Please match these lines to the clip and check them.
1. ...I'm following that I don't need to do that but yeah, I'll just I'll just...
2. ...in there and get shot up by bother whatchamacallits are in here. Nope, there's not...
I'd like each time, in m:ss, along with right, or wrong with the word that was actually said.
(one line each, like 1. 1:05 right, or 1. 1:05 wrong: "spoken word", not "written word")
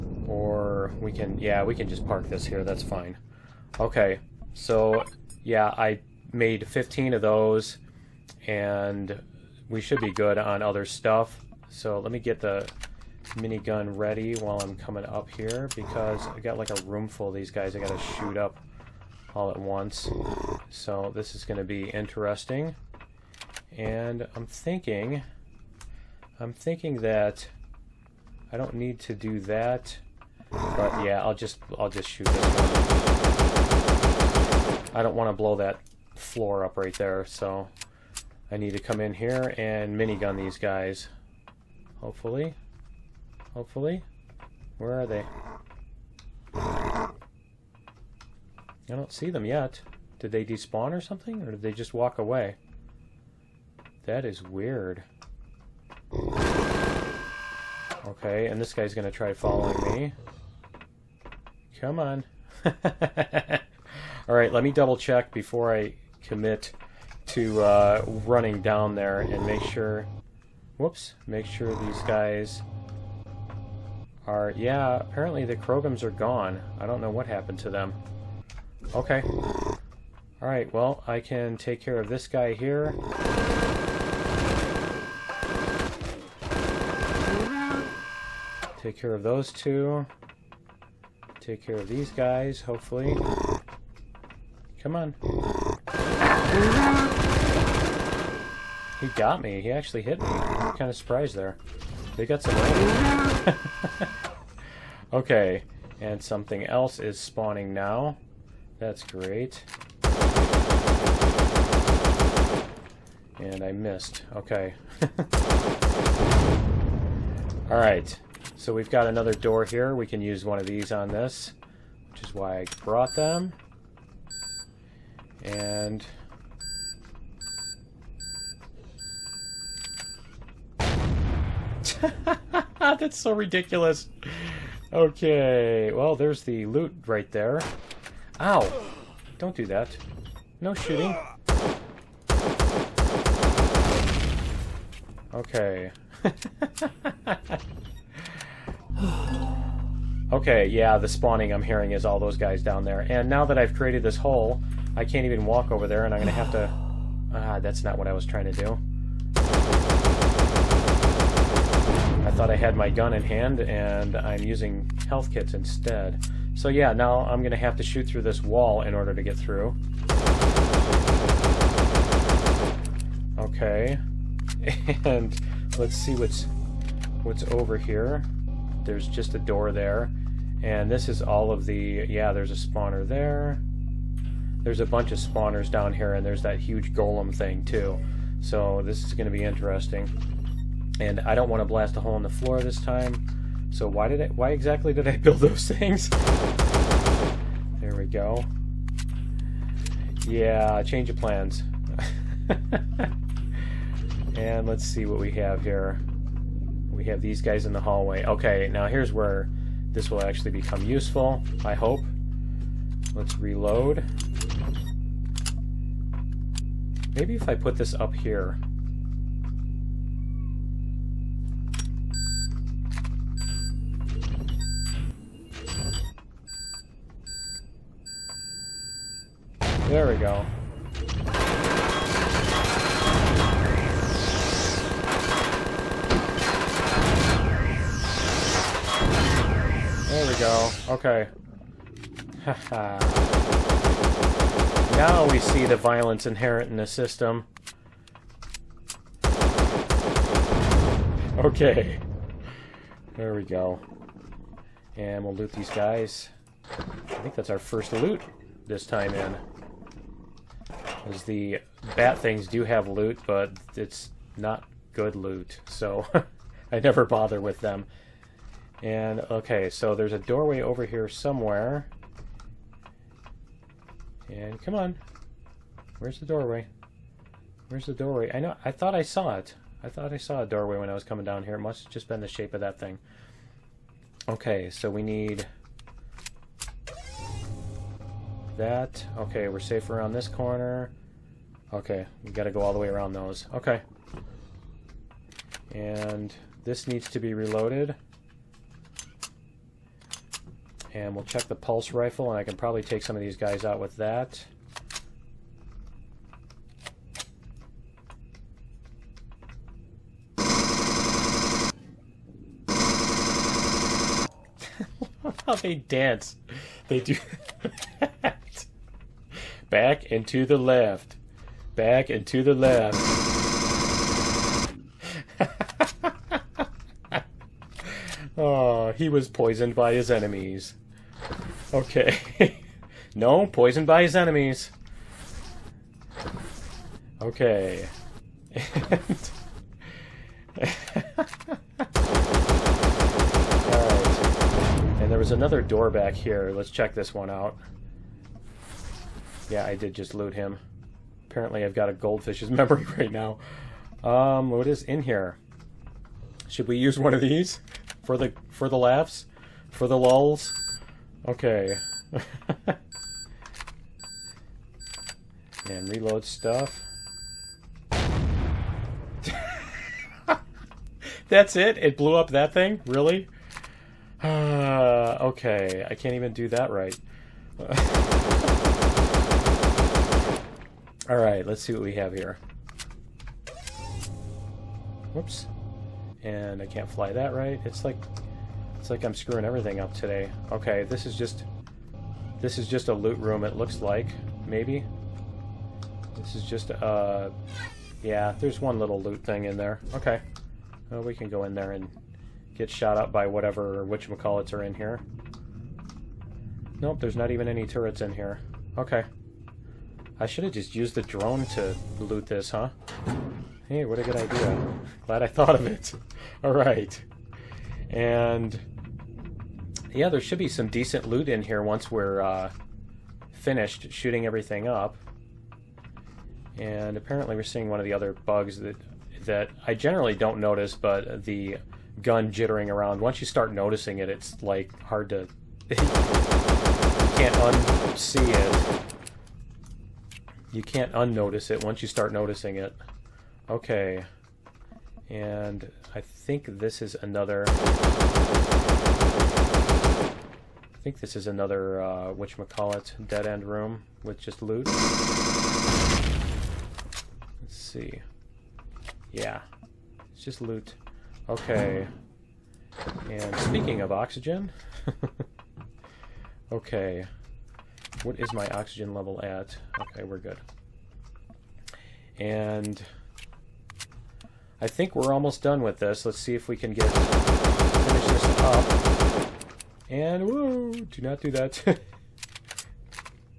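1. 0:26 wrong: "thinking", not "following"
2. 6:41 wrong: "whatever", not "bother".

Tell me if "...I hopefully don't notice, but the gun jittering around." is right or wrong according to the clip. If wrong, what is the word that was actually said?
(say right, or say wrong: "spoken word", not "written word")
wrong: "generally", not "hopefully".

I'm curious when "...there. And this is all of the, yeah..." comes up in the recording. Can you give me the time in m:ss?
2:59.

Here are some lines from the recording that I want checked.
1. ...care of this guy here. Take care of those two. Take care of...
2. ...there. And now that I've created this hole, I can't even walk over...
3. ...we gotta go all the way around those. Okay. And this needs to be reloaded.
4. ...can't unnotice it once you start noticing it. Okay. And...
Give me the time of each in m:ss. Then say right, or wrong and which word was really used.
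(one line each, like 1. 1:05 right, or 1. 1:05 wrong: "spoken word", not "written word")
1. 1:21 right
2. 2:32 right
3. 4:52 right
4. 7:20 right.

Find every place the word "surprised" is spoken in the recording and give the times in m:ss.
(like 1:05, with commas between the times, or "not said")
1:40.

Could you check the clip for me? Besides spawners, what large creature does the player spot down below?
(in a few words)
golem.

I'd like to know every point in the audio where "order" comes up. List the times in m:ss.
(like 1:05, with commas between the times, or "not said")
2:48.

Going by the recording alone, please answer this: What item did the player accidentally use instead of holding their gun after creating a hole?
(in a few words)
health kits.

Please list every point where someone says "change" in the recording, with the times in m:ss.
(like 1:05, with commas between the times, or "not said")
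3:20.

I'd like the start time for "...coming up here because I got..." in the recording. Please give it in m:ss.
0:14.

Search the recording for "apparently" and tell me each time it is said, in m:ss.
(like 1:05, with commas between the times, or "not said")
1:14, 5:51, 7:06.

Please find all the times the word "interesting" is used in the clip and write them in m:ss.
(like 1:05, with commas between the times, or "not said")
0:21, 3:09.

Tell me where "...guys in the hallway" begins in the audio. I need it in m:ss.
3:27.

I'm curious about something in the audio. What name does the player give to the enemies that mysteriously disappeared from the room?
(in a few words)
Krogums.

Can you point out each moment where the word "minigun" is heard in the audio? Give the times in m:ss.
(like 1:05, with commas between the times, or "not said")
0:13, 0:39.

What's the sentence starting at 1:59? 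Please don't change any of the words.
We can use one of these on this, which is why I brought them.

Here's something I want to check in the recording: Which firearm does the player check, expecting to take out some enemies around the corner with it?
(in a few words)
pulse rifle.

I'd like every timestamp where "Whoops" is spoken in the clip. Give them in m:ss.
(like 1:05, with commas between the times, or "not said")
1:10, 6:25.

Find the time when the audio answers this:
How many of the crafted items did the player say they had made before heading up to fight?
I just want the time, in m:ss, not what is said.
0:06.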